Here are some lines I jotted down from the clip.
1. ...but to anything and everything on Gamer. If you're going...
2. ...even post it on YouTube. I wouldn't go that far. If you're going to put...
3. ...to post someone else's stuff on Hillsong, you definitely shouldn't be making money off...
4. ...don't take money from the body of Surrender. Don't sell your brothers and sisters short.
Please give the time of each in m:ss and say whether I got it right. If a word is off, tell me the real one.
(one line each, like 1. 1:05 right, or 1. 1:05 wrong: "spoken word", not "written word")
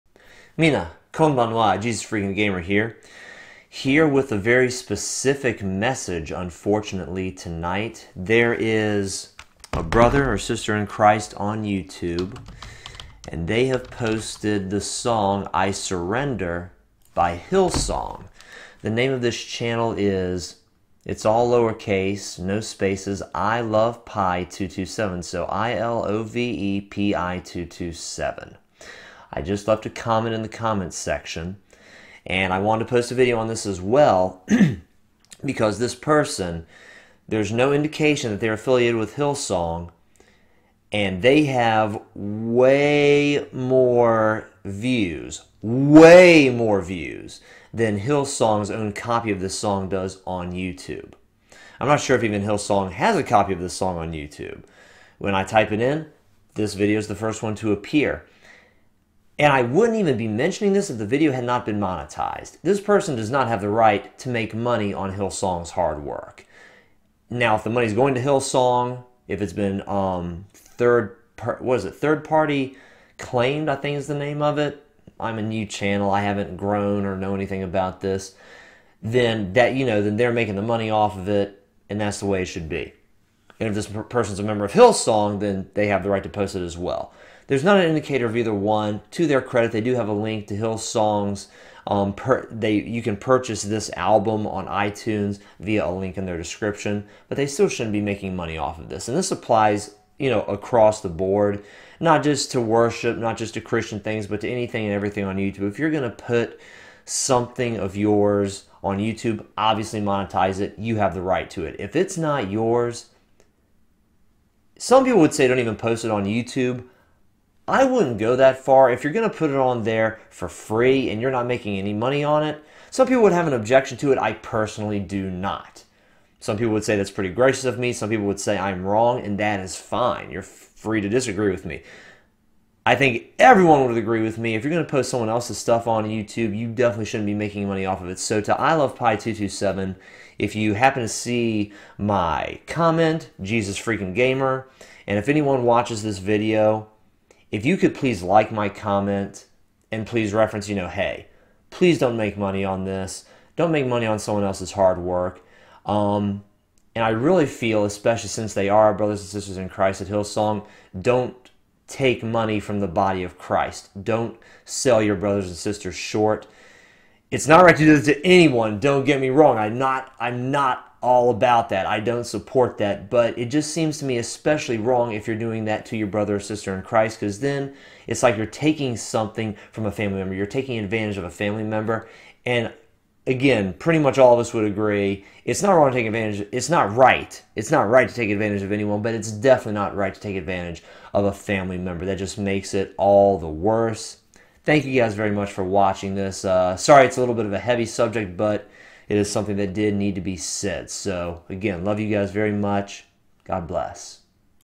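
1. 1:44 wrong: "YouTube", not "Gamer"
2. 1:55 right
3. 2:14 wrong: "YouTube", not "Hillsong"
4. 2:40 wrong: "Christ", not "Surrender".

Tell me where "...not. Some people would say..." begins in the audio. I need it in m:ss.
2:05.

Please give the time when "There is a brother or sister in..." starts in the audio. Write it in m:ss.
0:08.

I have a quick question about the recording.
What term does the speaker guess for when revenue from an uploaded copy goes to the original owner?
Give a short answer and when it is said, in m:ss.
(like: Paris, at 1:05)
third party claimed, at 1:11.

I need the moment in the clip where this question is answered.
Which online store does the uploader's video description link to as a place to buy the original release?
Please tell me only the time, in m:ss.
1:34.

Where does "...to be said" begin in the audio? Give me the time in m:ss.
3:20.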